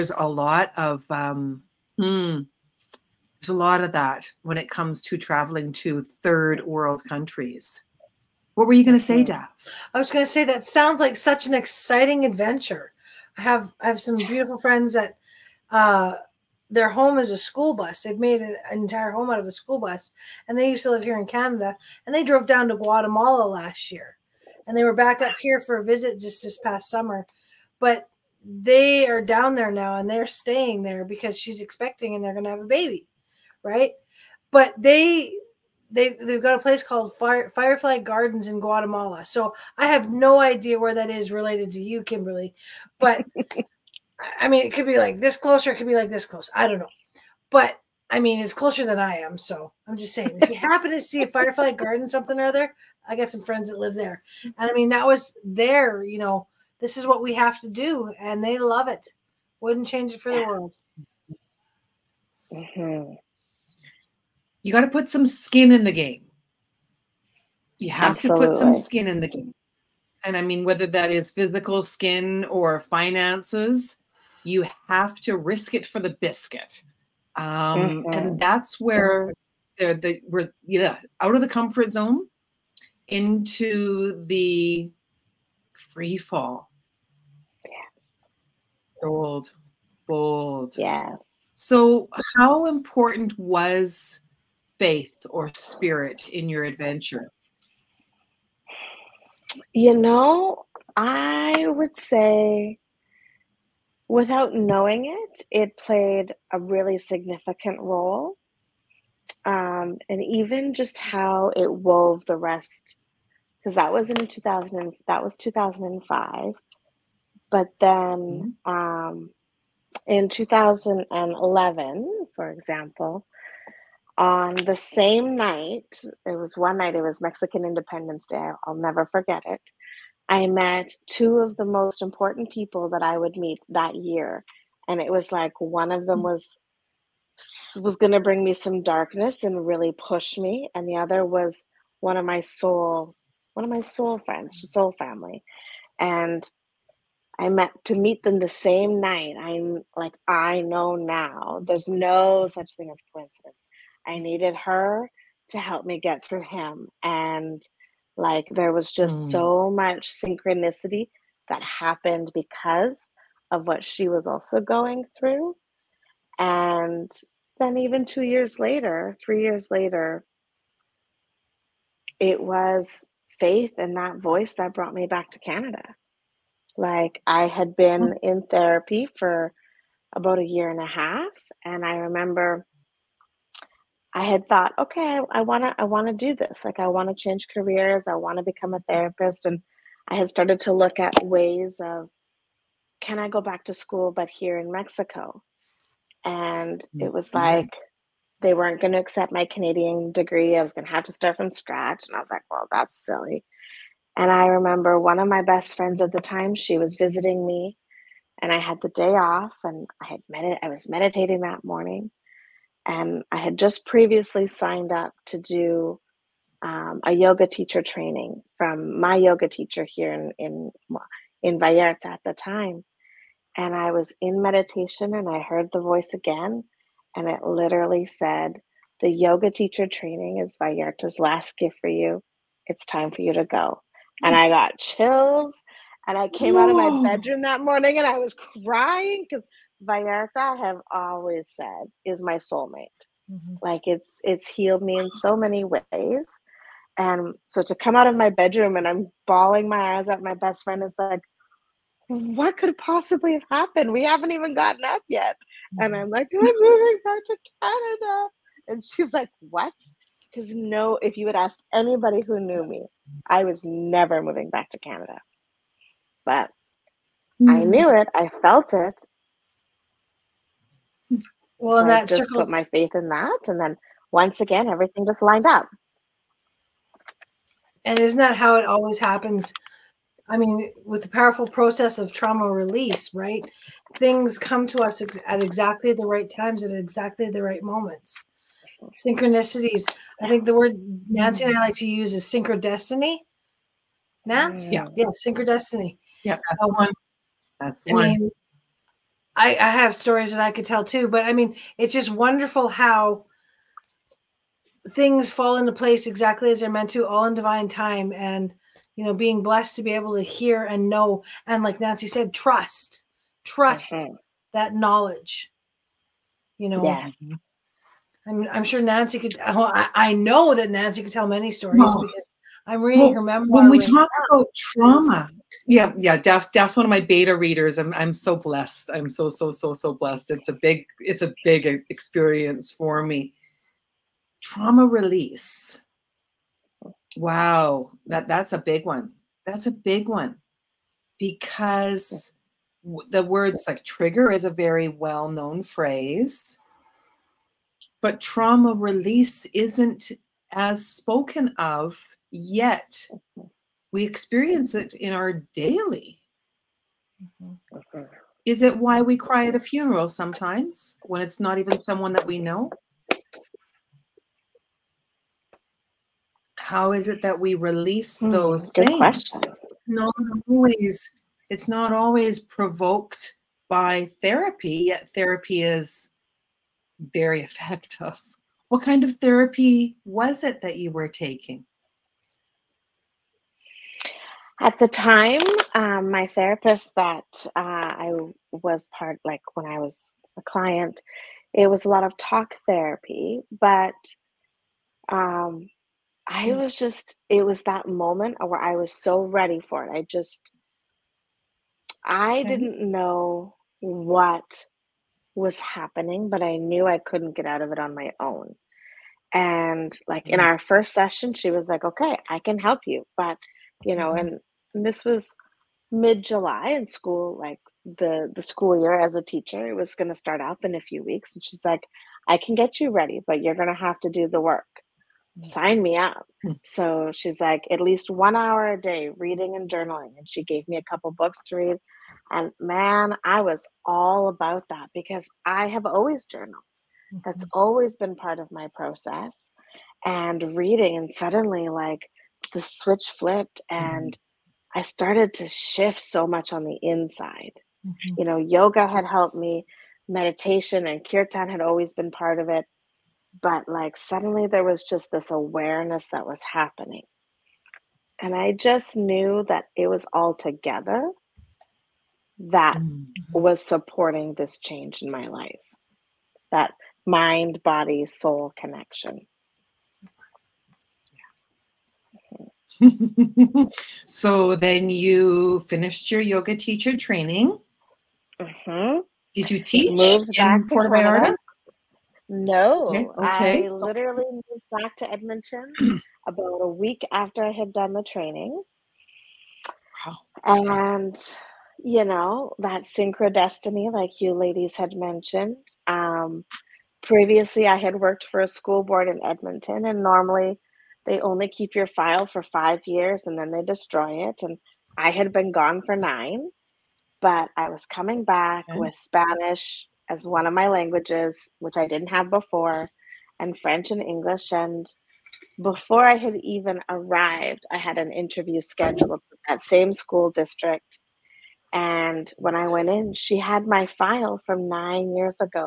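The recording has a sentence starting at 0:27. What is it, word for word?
But they are down there now, and they're staying there because she's expecting, and they're going to have a baby right?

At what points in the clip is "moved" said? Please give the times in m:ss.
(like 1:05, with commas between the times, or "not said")
7:59, 8:04.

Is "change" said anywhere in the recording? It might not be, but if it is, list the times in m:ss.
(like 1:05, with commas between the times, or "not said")
0:59, 3:07, 7:44.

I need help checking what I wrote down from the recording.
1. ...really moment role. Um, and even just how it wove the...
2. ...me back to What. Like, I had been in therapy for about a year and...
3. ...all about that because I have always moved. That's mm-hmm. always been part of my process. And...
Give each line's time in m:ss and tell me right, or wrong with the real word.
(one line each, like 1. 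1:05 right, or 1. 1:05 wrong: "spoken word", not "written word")
1. 1:46 wrong: "significant", not "moment"
2. 2:54 wrong: "Canada", not "What"
3. 7:13 wrong: "journaled", not "moved".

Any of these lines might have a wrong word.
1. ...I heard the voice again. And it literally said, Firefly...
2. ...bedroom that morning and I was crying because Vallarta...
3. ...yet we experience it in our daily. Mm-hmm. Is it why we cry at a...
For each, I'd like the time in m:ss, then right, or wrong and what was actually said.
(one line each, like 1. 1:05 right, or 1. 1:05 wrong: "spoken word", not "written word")
1. 3:45 wrong: "The", not "Firefly"
2. 3:57 right
3. 5:52 right.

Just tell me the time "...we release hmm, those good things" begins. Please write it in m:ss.
6:07.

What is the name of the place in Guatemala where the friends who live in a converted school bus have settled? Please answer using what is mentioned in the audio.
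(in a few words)
Firefly Gardens.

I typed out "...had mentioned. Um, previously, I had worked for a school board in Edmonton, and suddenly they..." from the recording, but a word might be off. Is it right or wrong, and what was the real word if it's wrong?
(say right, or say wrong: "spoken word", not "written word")
wrong: "normally", not "suddenly".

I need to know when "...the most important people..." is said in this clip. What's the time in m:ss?
2:11.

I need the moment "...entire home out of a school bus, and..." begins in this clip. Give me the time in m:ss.
0:18.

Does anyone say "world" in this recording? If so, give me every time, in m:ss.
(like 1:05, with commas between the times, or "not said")
0:06, 1:00.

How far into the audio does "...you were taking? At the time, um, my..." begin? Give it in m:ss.
6:20.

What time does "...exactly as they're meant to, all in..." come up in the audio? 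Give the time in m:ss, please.
5:06.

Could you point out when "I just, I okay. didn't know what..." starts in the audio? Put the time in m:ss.
6:39.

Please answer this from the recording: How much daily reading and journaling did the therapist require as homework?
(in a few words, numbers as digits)
1 hour.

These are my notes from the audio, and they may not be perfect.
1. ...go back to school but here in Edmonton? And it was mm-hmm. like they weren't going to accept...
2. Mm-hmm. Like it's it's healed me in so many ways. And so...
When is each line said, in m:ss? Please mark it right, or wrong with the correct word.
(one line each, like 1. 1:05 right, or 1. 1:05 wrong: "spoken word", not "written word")
1. 3:13 wrong: "Mexico", not "Edmonton"
2. 4:03 right.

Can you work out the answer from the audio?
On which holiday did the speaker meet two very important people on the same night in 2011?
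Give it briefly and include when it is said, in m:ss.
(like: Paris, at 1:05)
Mexican Independence Day, at 2:07.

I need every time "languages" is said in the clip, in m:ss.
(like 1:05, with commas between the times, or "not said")
8:30.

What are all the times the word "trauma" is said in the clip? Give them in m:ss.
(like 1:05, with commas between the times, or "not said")
4:42, 5:24, 5:34, 5:48.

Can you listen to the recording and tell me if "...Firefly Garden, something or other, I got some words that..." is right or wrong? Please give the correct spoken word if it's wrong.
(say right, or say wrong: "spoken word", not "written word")
wrong: "friends", not "words".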